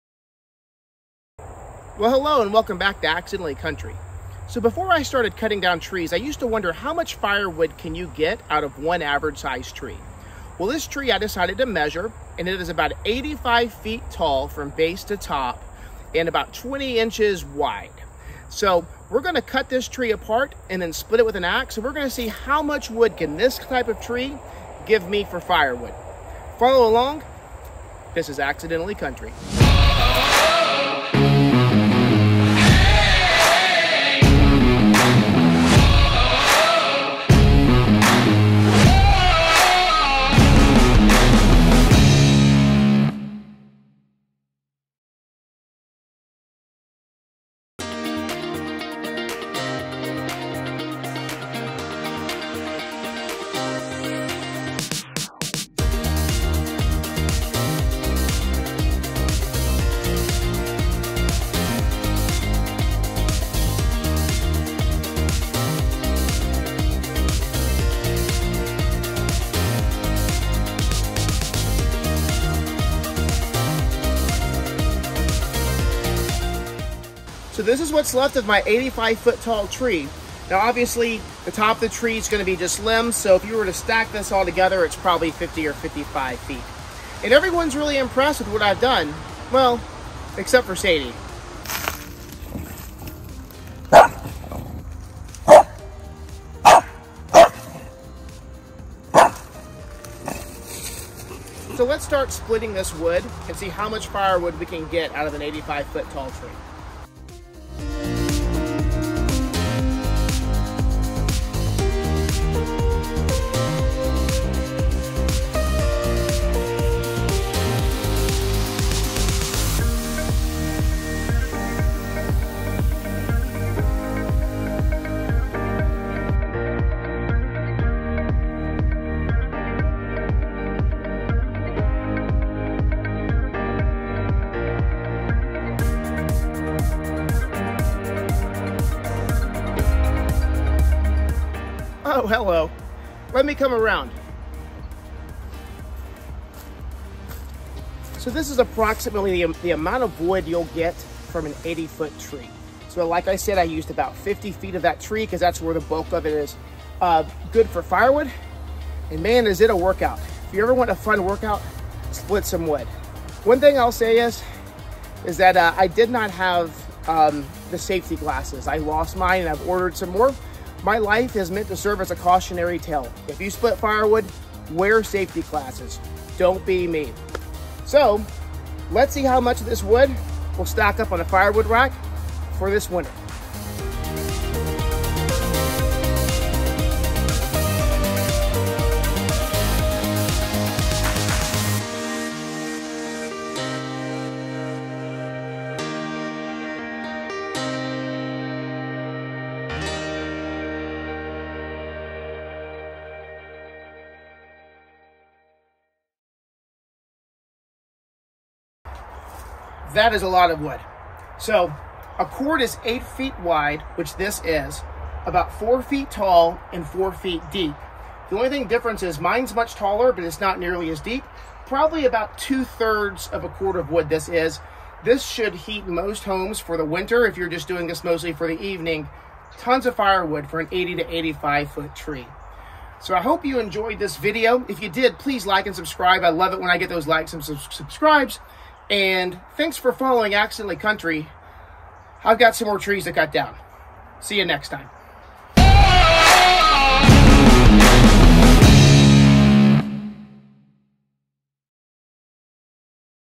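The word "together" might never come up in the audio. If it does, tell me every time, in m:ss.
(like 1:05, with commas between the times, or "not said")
1:24.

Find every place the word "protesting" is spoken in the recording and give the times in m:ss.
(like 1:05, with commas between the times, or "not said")
not said.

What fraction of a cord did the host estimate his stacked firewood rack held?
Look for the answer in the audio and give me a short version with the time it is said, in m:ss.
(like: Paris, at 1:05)
2/3, at 3:42.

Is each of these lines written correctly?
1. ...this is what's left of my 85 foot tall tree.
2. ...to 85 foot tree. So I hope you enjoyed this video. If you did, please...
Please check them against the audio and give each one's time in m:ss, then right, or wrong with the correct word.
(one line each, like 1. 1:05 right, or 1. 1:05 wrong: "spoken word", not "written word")
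1. 1:17 right
2. 3:50 right.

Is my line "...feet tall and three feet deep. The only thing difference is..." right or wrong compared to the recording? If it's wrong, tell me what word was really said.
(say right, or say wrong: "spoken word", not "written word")
wrong: "four", not "three".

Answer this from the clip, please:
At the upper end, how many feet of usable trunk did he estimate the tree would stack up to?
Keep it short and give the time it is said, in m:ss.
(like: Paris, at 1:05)
55 feet, at 1:25.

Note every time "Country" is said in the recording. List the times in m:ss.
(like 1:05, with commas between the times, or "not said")
0:03, 0:28, 4:00.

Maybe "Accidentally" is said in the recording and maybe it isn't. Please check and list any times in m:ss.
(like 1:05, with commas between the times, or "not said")
0:03, 0:28, 4:00.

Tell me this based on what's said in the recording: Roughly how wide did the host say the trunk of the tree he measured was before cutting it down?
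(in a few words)
20 inches.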